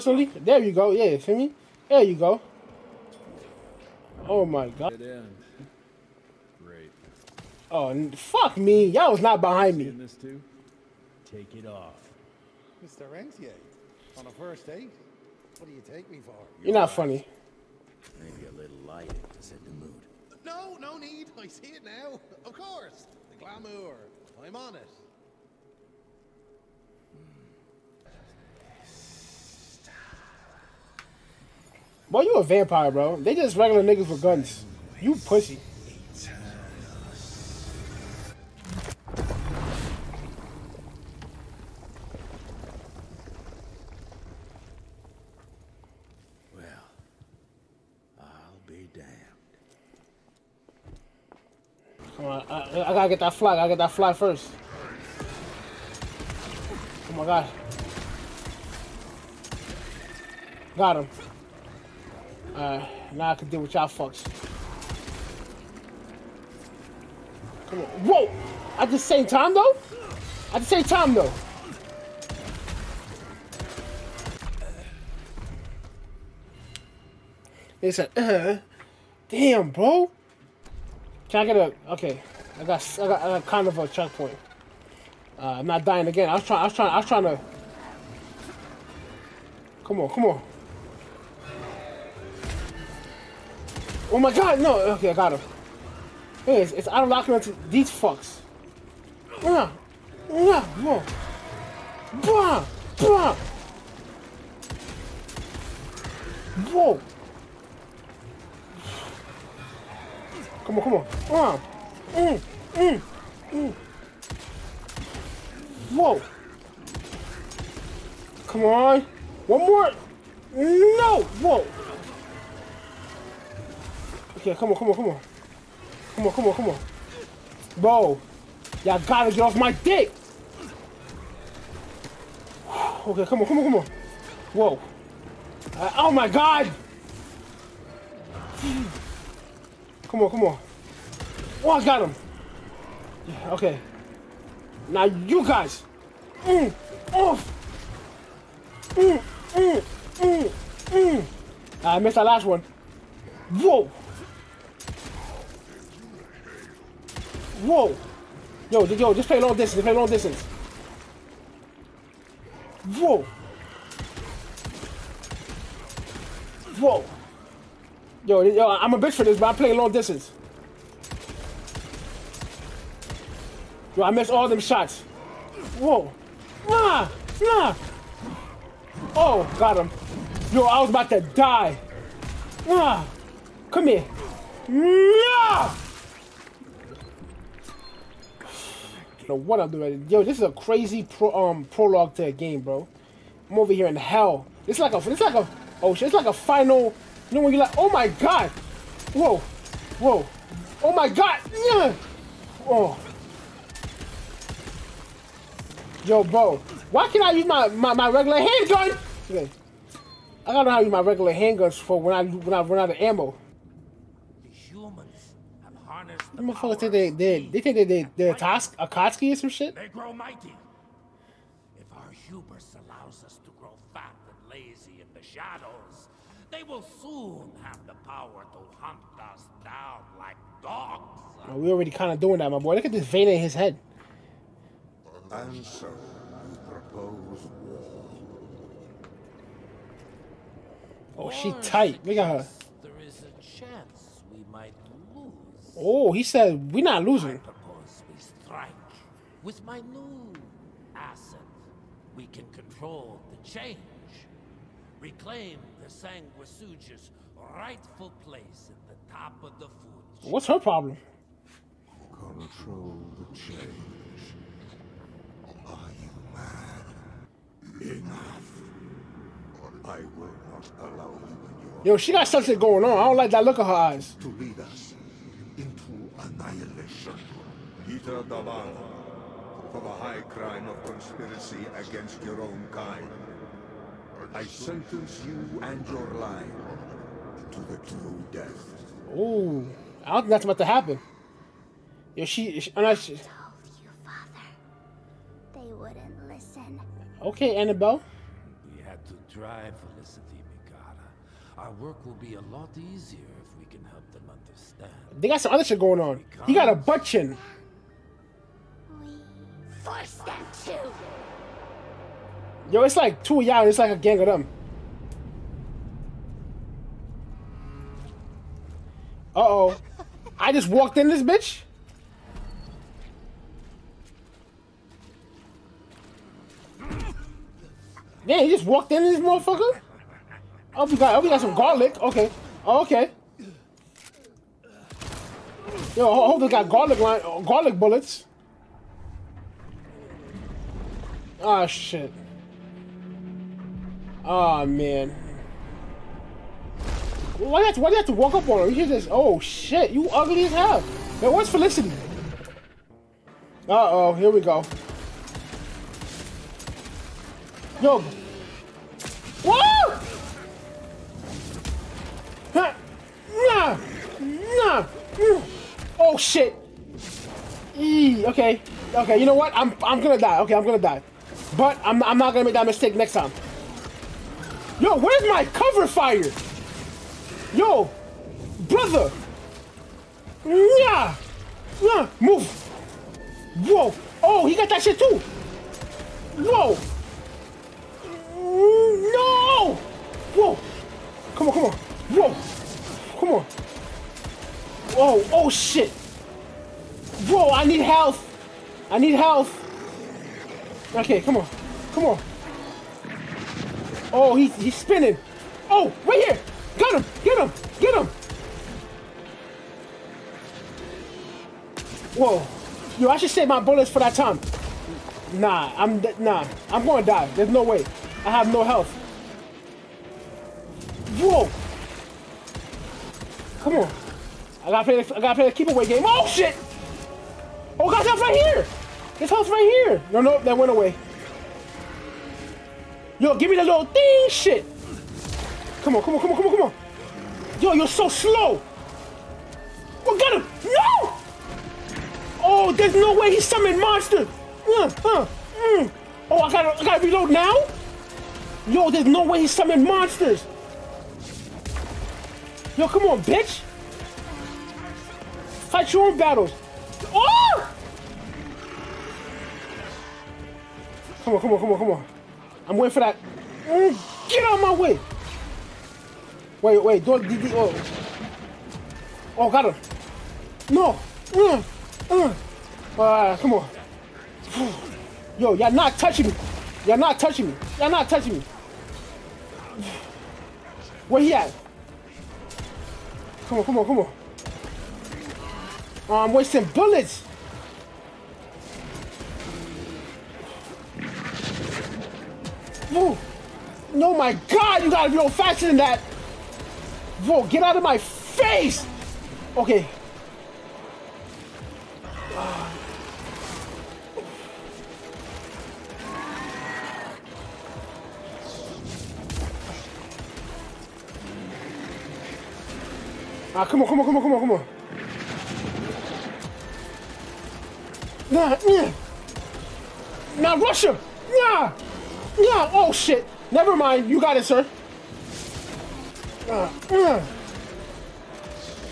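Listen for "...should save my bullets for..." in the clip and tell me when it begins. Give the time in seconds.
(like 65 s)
413 s.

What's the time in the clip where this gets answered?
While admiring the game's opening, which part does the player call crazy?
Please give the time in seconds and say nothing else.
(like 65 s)
191 s.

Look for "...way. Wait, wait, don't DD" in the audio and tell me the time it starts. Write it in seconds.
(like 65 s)
464 s.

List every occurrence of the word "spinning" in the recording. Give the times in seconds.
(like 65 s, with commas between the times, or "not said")
404 s.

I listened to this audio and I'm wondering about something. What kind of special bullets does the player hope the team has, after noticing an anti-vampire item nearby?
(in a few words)
Garlic bullets.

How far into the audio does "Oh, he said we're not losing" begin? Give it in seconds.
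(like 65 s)
245 s.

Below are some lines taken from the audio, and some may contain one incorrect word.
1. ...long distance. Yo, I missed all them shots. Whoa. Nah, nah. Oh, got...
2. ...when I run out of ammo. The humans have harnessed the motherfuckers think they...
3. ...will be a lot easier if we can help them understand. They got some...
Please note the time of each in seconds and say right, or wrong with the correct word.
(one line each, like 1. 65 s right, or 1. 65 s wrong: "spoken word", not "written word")
1. 169 s right
2. 212 s right
3. 302 s right.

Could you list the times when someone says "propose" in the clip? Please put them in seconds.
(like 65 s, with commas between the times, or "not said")
236 s, 247 s.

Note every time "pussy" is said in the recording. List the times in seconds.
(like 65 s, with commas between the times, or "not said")
35 s.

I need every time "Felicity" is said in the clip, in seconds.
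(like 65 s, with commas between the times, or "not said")
299 s, 351 s.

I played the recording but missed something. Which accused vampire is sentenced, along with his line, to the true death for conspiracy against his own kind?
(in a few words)
Peter D'Abano.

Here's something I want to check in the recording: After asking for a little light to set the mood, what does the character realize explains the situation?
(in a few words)
The glamour.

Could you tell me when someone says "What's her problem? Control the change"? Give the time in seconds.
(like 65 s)
260 s.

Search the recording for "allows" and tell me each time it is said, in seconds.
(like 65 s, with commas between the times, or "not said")
222 s, 270 s.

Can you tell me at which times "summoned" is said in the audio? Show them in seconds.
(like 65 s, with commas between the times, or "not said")
443 s, 449 s.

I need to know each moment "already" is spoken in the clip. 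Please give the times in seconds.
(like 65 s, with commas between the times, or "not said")
231 s.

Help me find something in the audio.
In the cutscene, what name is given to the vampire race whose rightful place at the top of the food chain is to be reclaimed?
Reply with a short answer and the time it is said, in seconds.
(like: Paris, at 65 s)
Sanguisuga, at 255 s.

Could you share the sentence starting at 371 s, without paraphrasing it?
But I'm I'm not gonna make that mistake next time.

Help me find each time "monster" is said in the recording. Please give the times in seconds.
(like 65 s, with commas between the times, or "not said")
443 s, 449 s.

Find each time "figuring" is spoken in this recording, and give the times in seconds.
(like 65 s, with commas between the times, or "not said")
not said.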